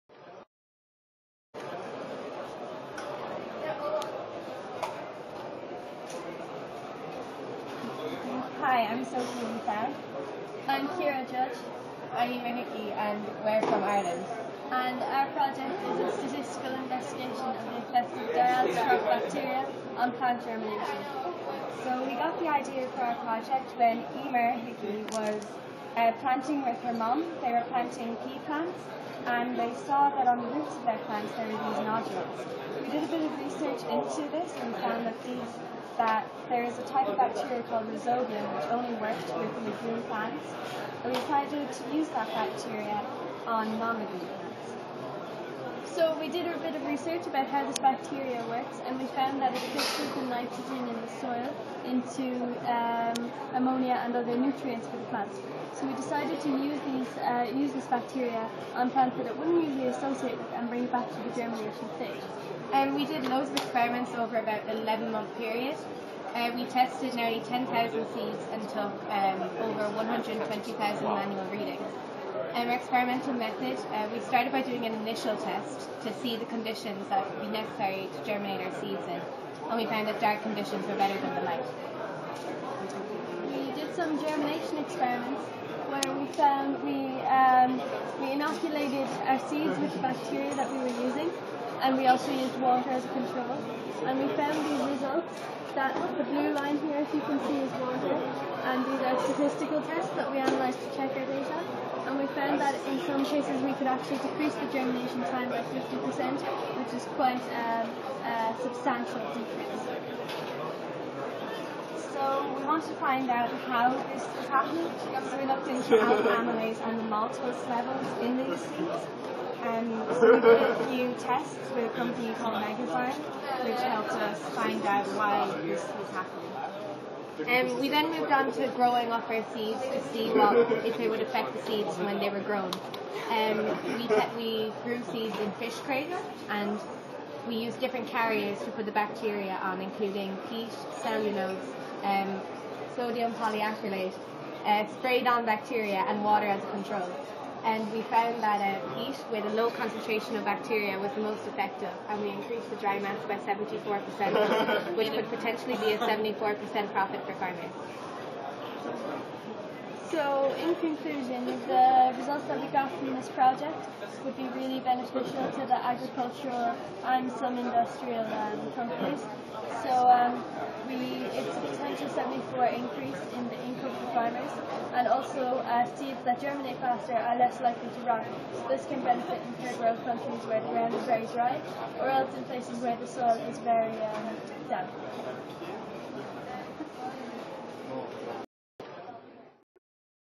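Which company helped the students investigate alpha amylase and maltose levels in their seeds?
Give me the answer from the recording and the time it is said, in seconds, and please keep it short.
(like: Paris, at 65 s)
Megazyme, at 122 s.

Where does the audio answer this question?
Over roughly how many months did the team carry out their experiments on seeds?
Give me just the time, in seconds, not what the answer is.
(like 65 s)
64 s.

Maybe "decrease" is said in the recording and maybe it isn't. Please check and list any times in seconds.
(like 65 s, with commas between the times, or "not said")
104 s, 109 s.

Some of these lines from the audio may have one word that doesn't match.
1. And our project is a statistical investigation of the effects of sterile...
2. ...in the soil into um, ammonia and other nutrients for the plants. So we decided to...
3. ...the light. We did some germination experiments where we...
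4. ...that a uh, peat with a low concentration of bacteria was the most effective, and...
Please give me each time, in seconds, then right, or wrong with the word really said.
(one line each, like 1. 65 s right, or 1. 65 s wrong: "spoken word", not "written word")
1. 14 s right
2. 50 s right
3. 81 s right
4. 148 s right.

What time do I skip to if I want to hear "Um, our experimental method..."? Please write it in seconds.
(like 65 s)
72 s.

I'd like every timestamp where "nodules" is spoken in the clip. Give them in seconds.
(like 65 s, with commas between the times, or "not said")
31 s.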